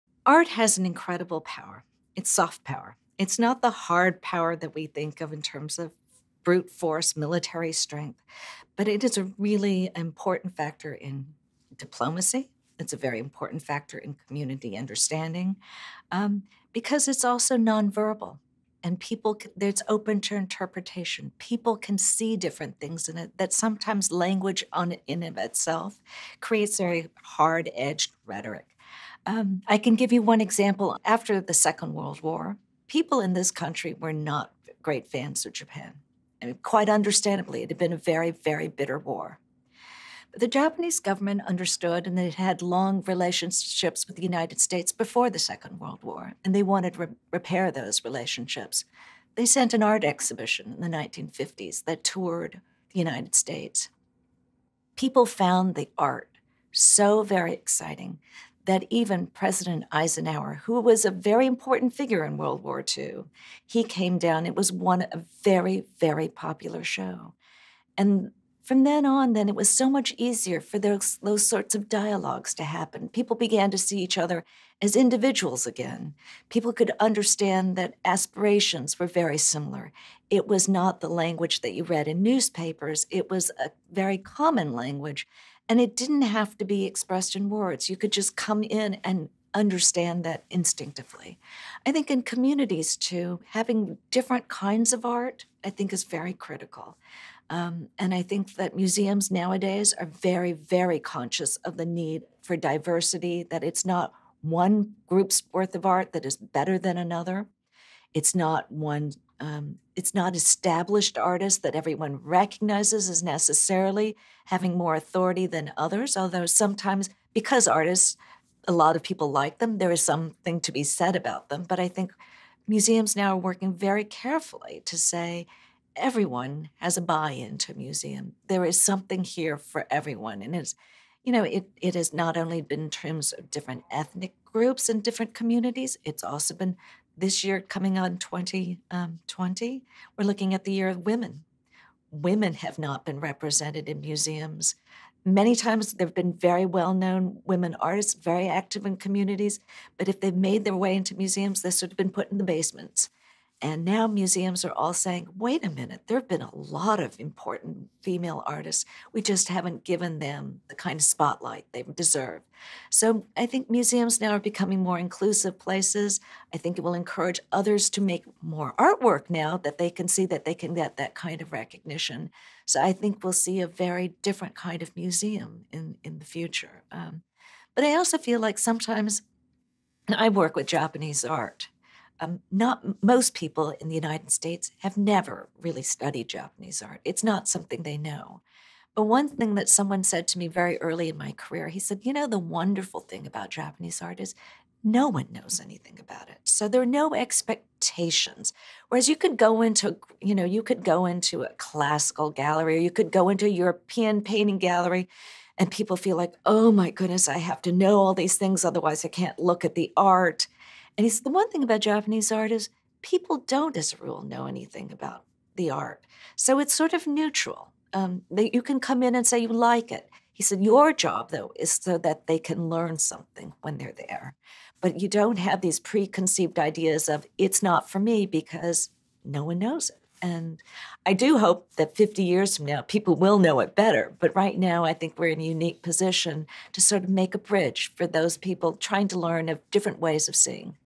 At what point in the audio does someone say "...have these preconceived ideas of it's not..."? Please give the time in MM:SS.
03:45.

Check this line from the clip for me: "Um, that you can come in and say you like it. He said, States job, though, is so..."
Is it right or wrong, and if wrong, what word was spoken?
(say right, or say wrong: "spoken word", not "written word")
wrong: "Your", not "States".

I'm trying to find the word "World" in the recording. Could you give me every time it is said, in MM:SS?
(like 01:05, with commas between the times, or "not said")
00:31, 00:45, 01:02.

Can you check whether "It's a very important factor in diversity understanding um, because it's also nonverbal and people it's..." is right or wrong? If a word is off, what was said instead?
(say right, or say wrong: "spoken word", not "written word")
wrong: "community", not "diversity".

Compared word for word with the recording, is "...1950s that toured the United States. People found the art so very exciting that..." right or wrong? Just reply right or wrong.
right.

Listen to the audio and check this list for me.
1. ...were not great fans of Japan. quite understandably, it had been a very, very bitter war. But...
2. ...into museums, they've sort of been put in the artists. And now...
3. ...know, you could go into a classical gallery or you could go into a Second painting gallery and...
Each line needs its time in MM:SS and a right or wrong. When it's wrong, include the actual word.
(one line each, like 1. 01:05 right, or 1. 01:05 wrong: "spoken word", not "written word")
1. 00:33 right
2. 02:30 wrong: "basements", not "artists"
3. 03:20 wrong: "European", not "Second".